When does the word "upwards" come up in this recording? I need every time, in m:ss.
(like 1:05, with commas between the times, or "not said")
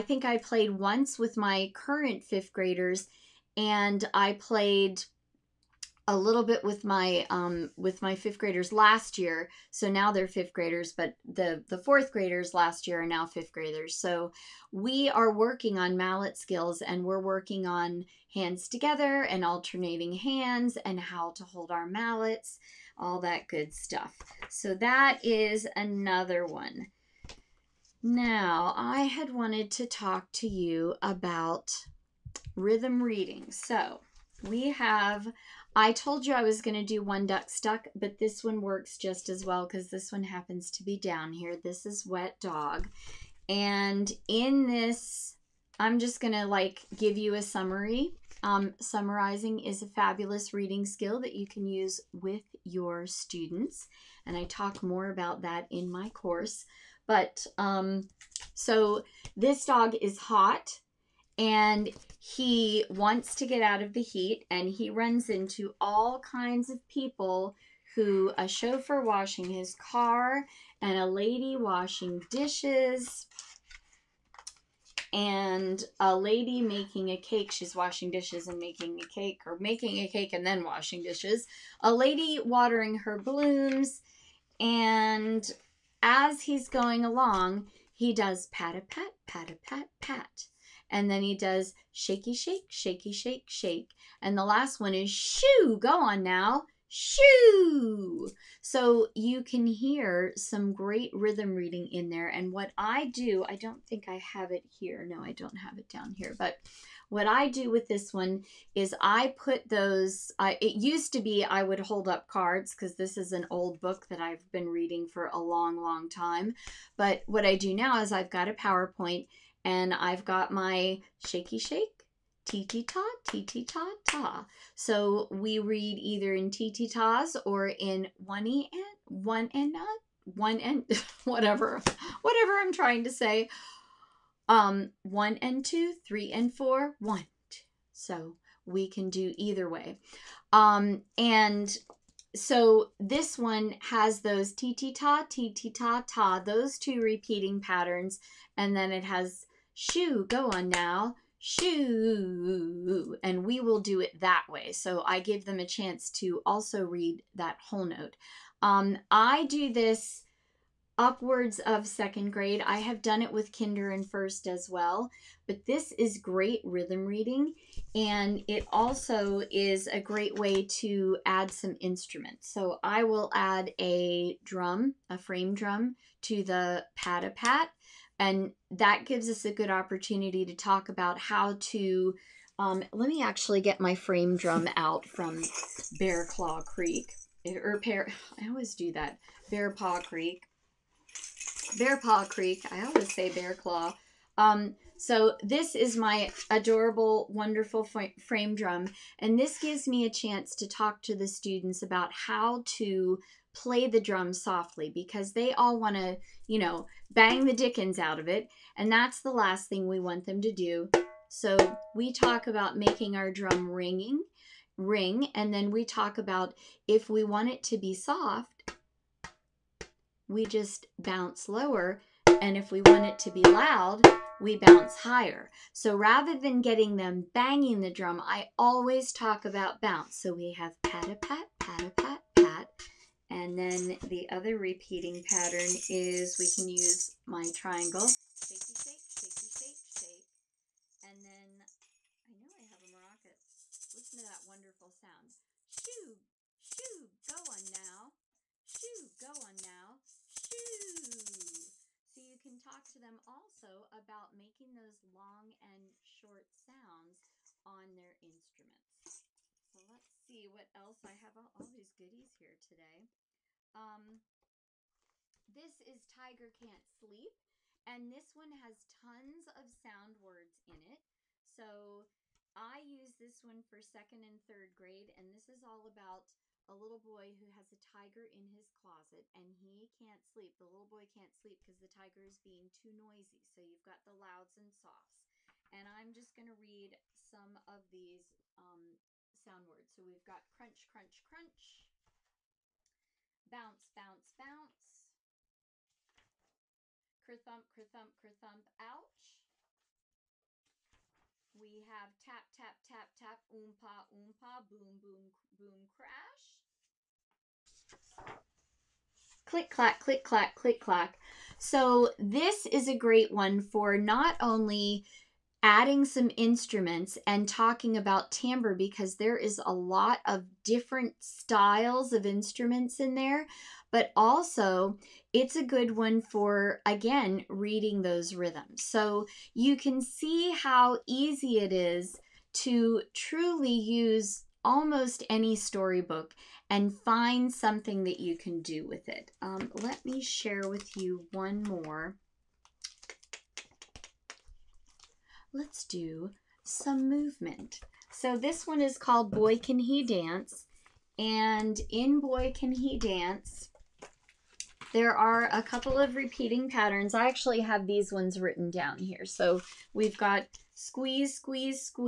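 2:40.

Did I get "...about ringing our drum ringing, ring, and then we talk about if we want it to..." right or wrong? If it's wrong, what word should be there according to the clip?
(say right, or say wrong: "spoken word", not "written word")
wrong: "making", not "ringing".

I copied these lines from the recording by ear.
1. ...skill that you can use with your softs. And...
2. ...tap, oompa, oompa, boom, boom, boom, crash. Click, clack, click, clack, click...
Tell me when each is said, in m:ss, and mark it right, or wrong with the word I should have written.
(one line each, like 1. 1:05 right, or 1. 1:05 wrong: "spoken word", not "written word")
1. 0:50 wrong: "students", not "softs"
2. 5:03 right.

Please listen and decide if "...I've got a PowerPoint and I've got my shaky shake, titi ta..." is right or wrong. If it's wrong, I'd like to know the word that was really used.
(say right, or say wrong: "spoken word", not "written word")
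right.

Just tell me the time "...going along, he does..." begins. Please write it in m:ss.
1:26.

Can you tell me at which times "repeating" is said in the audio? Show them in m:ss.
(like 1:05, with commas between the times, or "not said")
2:27, 3:54, 5:56.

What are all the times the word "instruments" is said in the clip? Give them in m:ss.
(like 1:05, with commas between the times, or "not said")
2:51, 4:18, 5:16, 5:22.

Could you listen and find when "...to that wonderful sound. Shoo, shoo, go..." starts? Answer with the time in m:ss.
4:04.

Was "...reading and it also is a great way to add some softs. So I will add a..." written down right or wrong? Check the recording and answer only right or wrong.
wrong.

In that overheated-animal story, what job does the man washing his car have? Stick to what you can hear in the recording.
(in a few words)
Chauffeur.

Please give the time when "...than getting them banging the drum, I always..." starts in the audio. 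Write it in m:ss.
3:46.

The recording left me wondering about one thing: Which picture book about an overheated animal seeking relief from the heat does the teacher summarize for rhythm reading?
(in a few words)
Wet Dog.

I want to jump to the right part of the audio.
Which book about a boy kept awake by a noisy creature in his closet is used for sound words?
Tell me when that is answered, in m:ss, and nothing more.
4:26.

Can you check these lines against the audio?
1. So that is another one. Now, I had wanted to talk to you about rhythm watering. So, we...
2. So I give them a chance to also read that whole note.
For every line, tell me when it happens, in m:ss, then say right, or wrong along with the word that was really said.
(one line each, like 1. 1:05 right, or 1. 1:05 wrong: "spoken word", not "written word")
1. 0:24 wrong: "reading", not "watering"
2. 2:34 right.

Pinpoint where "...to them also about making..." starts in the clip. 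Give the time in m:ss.
4:12.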